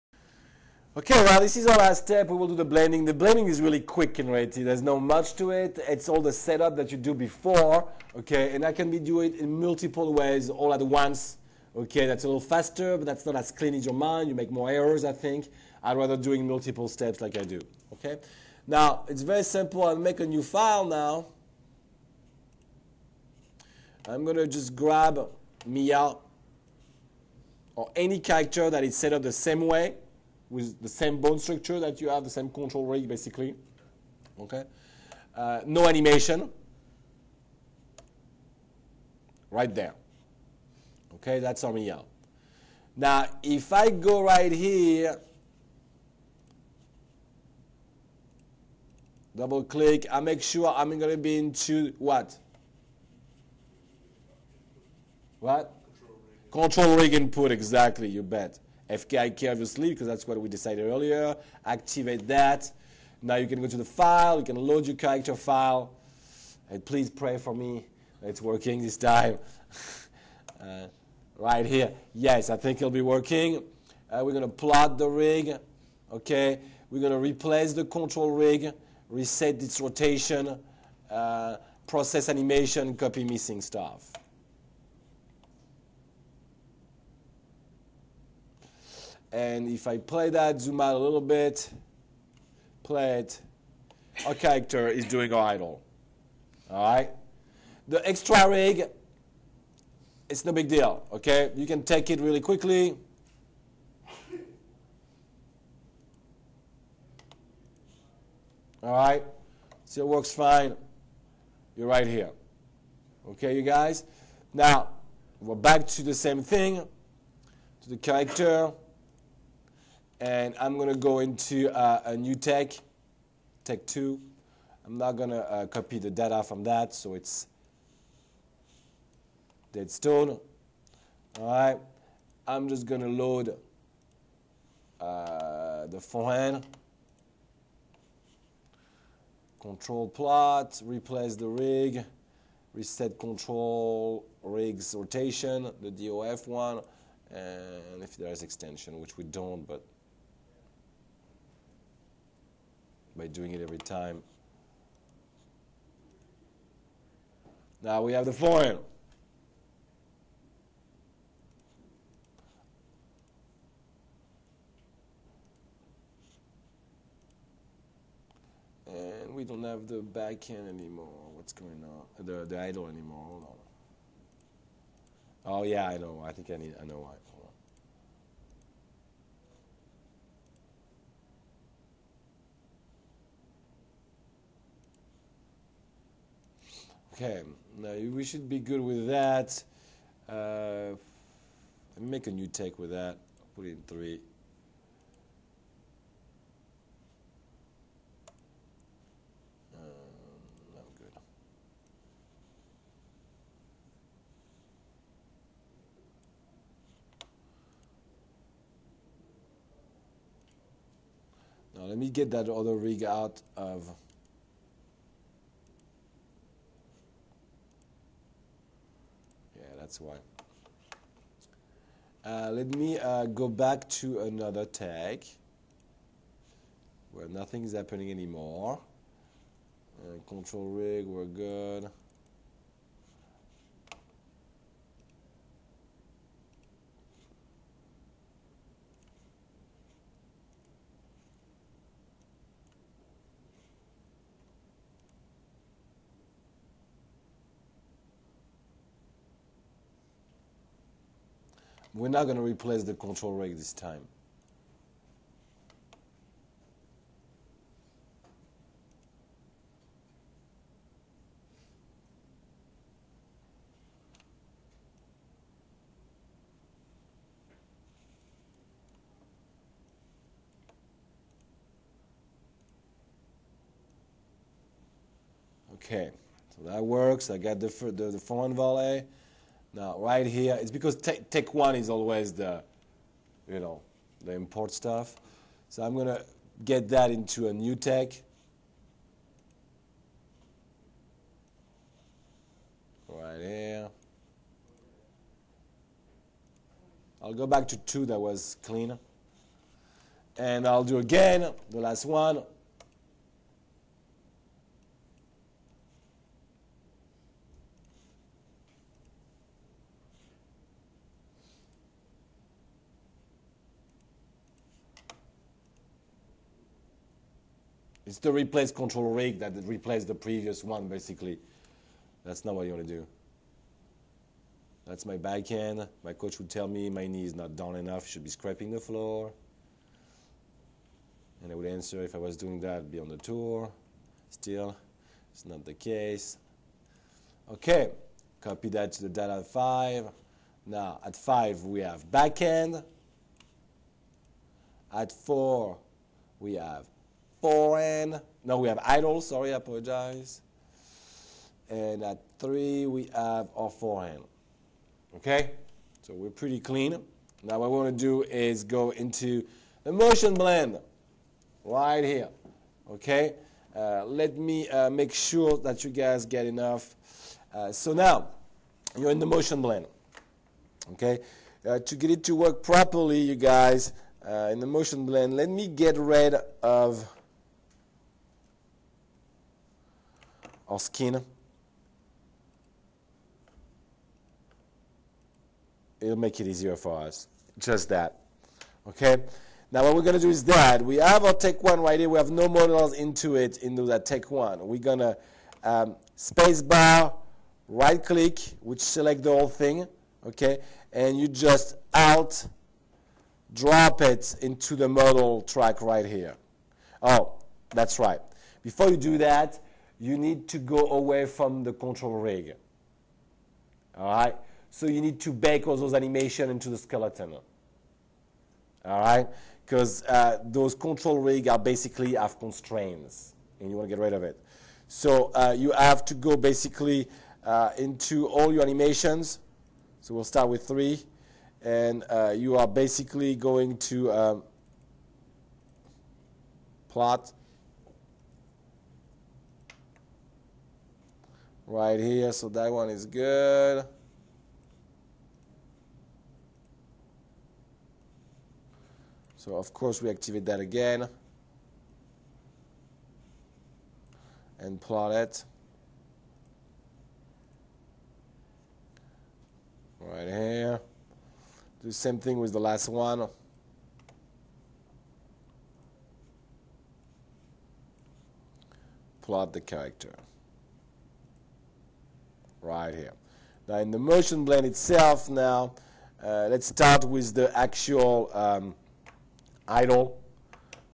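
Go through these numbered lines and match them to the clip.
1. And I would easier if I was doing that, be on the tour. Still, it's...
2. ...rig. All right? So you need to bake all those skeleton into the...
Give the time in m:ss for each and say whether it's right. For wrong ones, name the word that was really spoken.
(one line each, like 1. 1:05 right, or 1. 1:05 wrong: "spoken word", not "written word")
1. 5:31 wrong: "answer", not "easier"
2. 6:52 wrong: "animation", not "skeleton".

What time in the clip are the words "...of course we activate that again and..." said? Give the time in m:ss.
7:29.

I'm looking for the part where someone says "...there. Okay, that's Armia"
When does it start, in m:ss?
0:39.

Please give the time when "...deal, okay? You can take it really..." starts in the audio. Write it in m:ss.
1:40.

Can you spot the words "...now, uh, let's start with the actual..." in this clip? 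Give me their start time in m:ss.
7:55.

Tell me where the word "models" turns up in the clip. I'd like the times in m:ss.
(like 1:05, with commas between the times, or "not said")
6:32, 6:44.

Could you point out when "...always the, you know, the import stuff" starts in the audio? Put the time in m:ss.
4:41.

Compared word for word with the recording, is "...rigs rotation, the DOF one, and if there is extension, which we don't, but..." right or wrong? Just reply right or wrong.
right.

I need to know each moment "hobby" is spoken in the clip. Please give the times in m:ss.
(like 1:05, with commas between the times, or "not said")
not said.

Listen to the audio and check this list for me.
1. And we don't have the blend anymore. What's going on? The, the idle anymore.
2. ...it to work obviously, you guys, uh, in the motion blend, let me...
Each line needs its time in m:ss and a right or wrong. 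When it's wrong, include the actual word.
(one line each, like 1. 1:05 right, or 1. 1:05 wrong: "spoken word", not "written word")
1. 2:48 wrong: "backhand", not "blend"
2. 6:12 wrong: "properly", not "obviously".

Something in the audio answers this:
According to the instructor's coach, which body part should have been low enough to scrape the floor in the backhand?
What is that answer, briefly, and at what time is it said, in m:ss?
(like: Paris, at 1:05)
Knee, at 5:26.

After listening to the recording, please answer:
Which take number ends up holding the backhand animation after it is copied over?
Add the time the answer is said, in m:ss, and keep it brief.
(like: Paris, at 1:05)
5, at 5:41.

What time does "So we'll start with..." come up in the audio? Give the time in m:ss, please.
7:10.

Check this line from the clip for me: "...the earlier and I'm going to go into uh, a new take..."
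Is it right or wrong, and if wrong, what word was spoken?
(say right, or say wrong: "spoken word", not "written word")
wrong: "character", not "earlier".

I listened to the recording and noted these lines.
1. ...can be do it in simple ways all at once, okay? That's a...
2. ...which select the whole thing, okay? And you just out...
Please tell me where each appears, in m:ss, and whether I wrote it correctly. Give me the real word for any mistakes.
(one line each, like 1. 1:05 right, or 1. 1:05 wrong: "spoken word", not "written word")
1. 0:08 wrong: "multiple", not "simple"
2. 6:38 right.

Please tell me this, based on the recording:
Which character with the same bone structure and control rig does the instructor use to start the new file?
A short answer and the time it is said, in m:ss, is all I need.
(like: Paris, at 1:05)
Mia, at 0:25.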